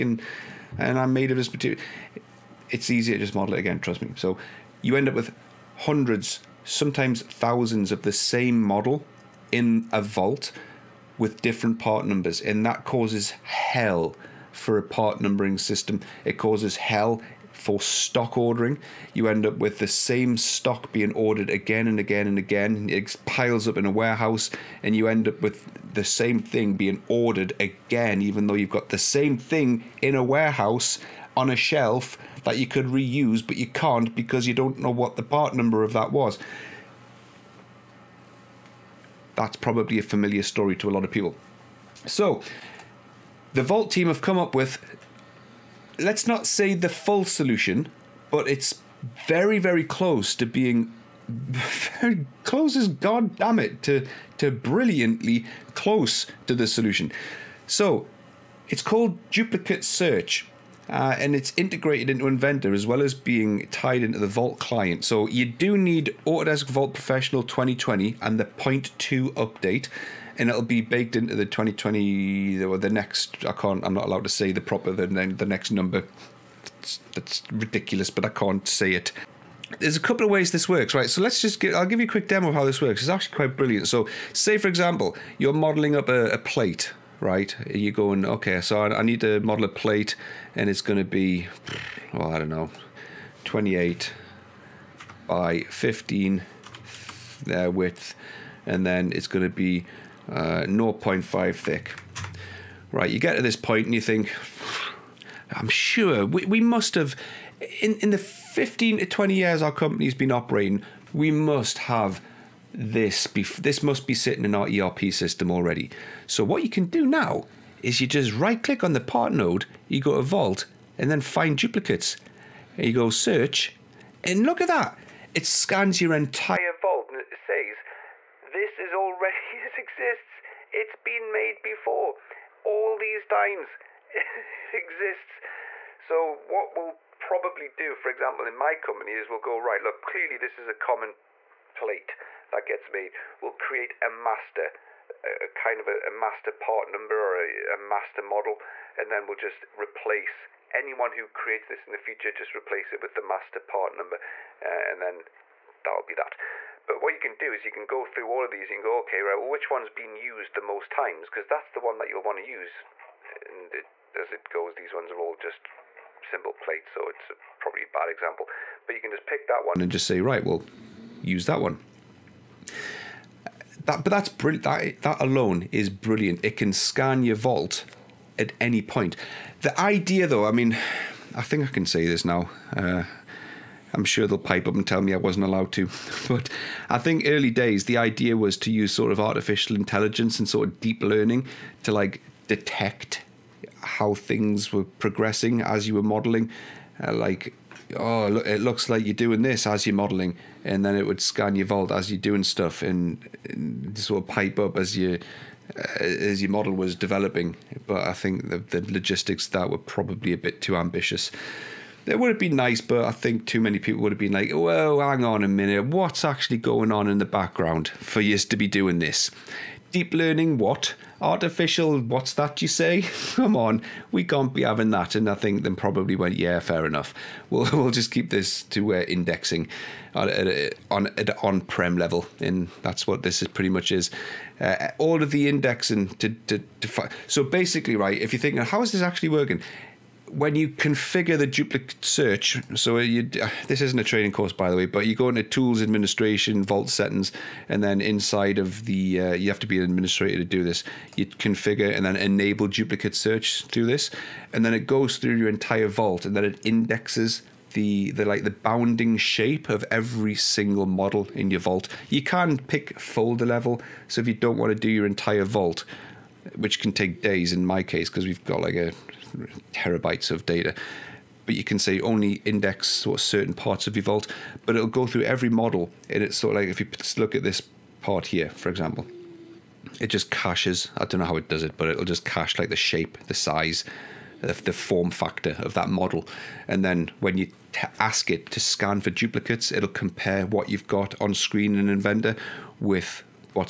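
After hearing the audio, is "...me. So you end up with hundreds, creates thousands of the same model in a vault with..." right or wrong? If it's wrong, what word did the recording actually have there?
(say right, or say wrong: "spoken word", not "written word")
wrong: "sometimes", not "creates".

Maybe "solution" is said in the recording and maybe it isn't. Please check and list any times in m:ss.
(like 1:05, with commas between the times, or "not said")
0:47, 0:56.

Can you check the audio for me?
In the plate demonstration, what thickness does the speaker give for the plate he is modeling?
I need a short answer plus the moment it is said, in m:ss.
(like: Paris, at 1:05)
0.5, at 1:40.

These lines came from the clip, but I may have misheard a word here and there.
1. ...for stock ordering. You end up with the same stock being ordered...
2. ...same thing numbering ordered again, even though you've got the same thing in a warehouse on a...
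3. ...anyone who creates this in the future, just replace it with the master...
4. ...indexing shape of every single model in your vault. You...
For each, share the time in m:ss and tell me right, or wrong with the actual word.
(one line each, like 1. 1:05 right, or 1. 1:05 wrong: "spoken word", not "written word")
1. 0:17 right
2. 0:26 wrong: "being", not "numbering"
3. 2:30 right
4. 4:18 wrong: "bounding", not "indexing".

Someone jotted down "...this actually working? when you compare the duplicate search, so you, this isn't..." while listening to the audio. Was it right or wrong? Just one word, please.
wrong.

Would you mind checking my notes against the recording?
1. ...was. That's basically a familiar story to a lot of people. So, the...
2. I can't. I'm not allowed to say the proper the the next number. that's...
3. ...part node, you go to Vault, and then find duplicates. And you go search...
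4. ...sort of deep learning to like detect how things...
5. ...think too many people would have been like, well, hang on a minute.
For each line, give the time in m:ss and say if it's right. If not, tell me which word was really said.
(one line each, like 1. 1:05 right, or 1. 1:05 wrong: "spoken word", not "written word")
1. 0:36 wrong: "probably", not "basically"
2. 1:13 right
3. 1:58 right
4. 3:10 right
5. 3:33 right.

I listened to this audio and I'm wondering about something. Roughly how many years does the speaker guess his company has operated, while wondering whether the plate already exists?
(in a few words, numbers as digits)
15 to 20.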